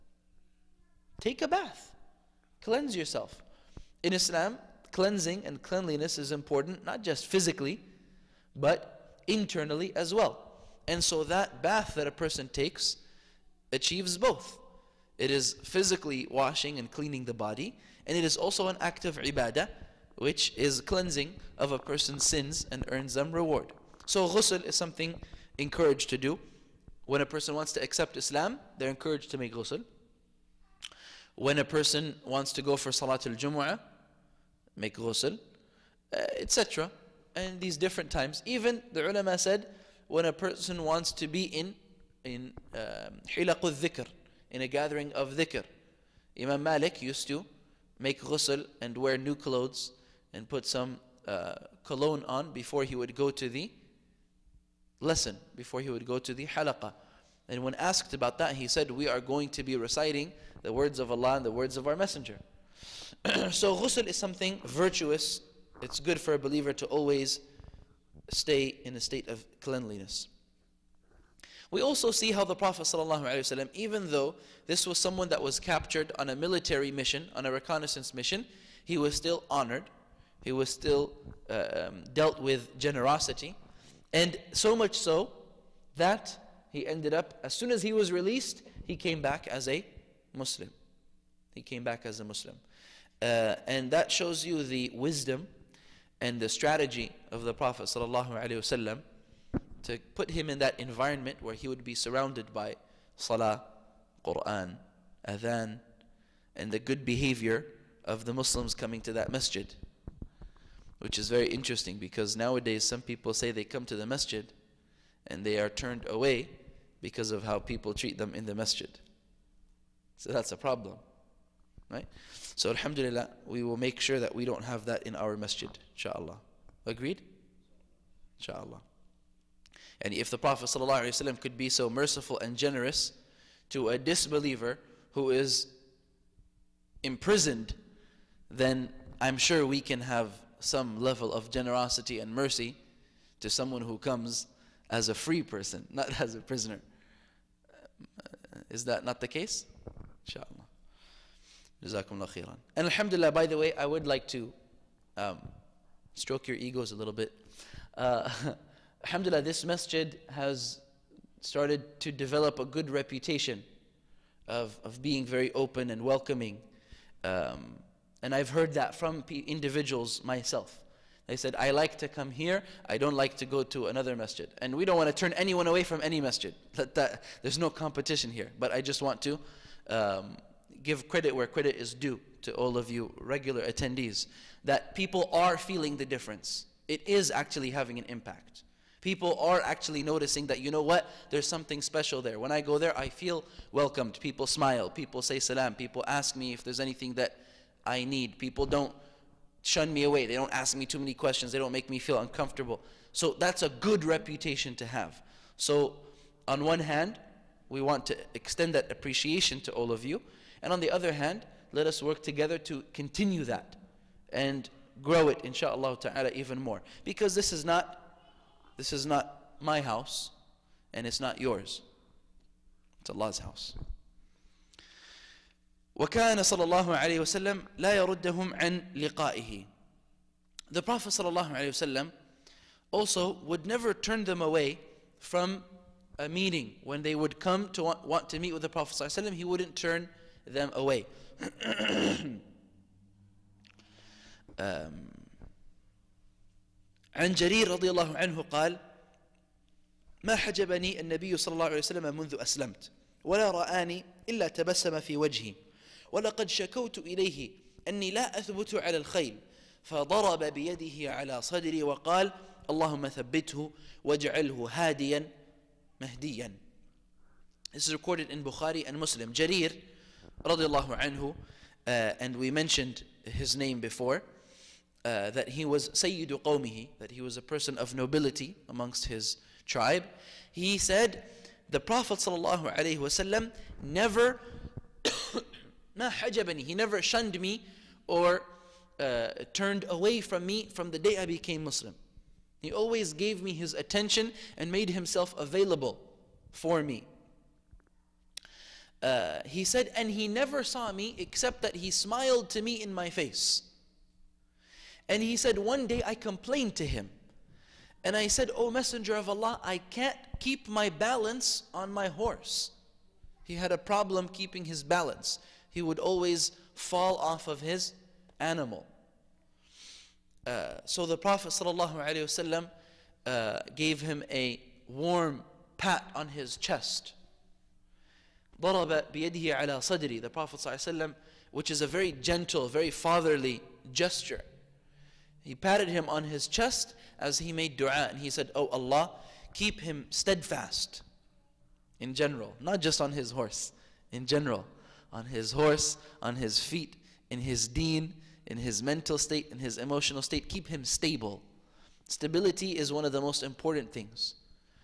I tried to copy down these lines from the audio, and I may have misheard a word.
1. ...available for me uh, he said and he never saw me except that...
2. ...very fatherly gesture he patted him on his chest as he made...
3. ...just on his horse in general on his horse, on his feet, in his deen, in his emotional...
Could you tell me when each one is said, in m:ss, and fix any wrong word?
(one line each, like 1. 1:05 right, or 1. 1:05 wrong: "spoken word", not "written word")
1. 4:55 right
2. 5:32 right
3. 5:42 wrong: "mental", not "emotional".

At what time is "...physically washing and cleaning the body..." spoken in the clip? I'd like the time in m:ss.
0:15.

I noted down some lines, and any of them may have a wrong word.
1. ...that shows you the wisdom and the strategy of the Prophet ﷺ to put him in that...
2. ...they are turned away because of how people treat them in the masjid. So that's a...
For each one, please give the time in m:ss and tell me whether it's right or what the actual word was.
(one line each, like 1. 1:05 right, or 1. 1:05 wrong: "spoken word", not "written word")
1. 1:33 right
2. 1:55 right.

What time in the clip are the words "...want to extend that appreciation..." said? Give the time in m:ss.
3:27.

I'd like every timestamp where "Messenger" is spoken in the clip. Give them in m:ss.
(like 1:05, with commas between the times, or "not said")
1:01, 5:08.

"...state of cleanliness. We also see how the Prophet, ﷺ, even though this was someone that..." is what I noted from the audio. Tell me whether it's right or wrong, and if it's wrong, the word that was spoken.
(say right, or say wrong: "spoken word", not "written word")
right.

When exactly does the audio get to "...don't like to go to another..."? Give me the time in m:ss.
2:52.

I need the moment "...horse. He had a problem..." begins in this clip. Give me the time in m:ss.
5:12.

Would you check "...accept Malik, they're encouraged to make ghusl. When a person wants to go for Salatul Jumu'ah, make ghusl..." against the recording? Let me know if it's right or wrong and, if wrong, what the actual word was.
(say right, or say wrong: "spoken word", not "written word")
wrong: "Islam", not "Malik".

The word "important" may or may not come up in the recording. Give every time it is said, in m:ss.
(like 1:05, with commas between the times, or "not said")
0:06, 5:53.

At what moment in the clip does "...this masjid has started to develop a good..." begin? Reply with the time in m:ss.
2:39.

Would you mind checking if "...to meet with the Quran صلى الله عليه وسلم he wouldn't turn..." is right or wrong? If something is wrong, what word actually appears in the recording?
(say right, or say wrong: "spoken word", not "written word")
wrong: "Prophet", not "Quran".